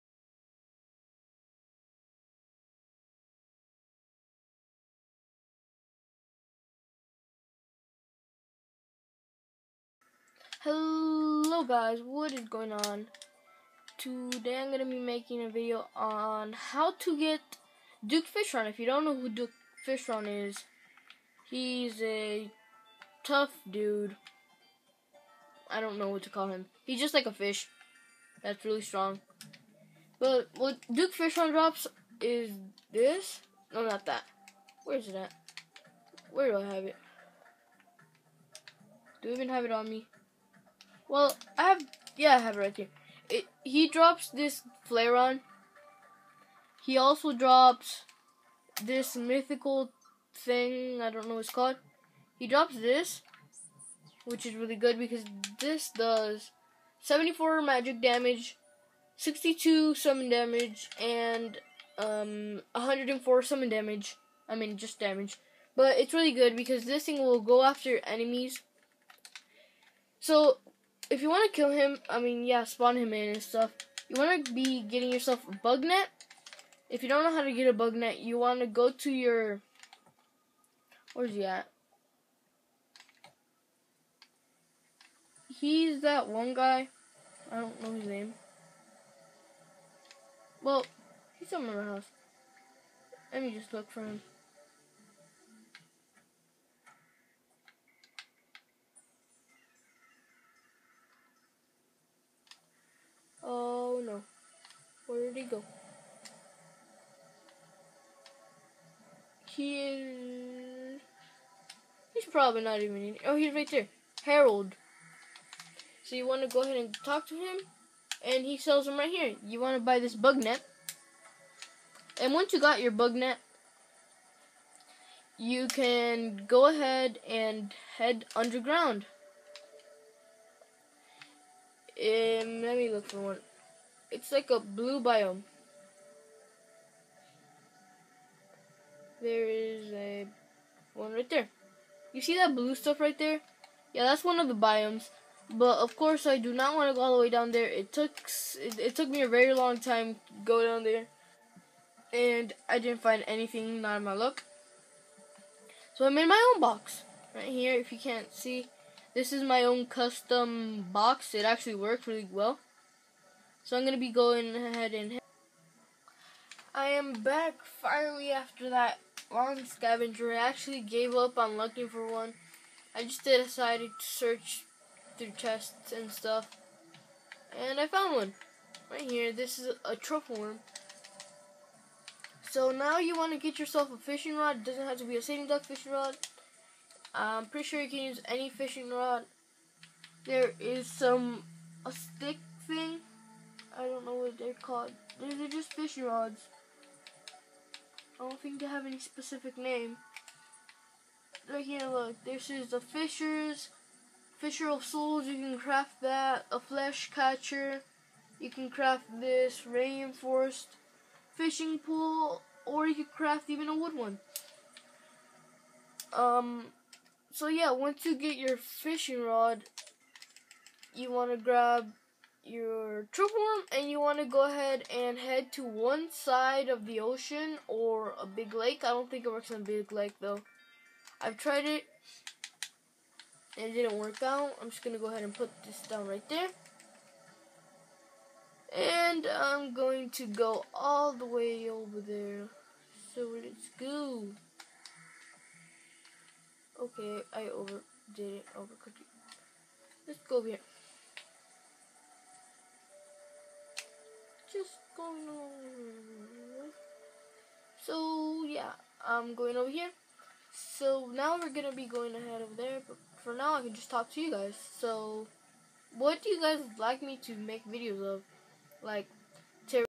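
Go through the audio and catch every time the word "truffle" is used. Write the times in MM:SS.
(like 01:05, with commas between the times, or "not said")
02:59, 03:43.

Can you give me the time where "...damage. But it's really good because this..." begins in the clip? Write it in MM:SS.
01:05.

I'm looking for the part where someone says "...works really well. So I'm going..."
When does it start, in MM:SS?
02:41.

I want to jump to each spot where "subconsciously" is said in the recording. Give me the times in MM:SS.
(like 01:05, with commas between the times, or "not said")
not said.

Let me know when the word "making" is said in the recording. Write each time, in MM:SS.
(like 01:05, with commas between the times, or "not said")
00:14.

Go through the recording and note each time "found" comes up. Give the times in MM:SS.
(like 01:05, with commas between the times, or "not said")
02:57.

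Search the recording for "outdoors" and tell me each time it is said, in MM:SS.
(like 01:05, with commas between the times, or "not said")
not said.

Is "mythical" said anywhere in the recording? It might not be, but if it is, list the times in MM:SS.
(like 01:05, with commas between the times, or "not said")
00:49.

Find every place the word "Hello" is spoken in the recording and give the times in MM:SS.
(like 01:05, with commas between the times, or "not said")
00:10.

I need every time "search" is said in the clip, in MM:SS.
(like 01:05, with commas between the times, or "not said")
02:54.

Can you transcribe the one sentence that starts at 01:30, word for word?
Well, he's somewhere in my house.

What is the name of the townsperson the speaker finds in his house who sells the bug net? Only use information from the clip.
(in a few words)
Harold.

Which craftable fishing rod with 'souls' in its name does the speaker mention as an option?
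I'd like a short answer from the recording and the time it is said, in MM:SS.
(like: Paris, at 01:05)
Fisher of Souls, at 03:24.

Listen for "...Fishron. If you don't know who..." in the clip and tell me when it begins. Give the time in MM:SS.
00:18.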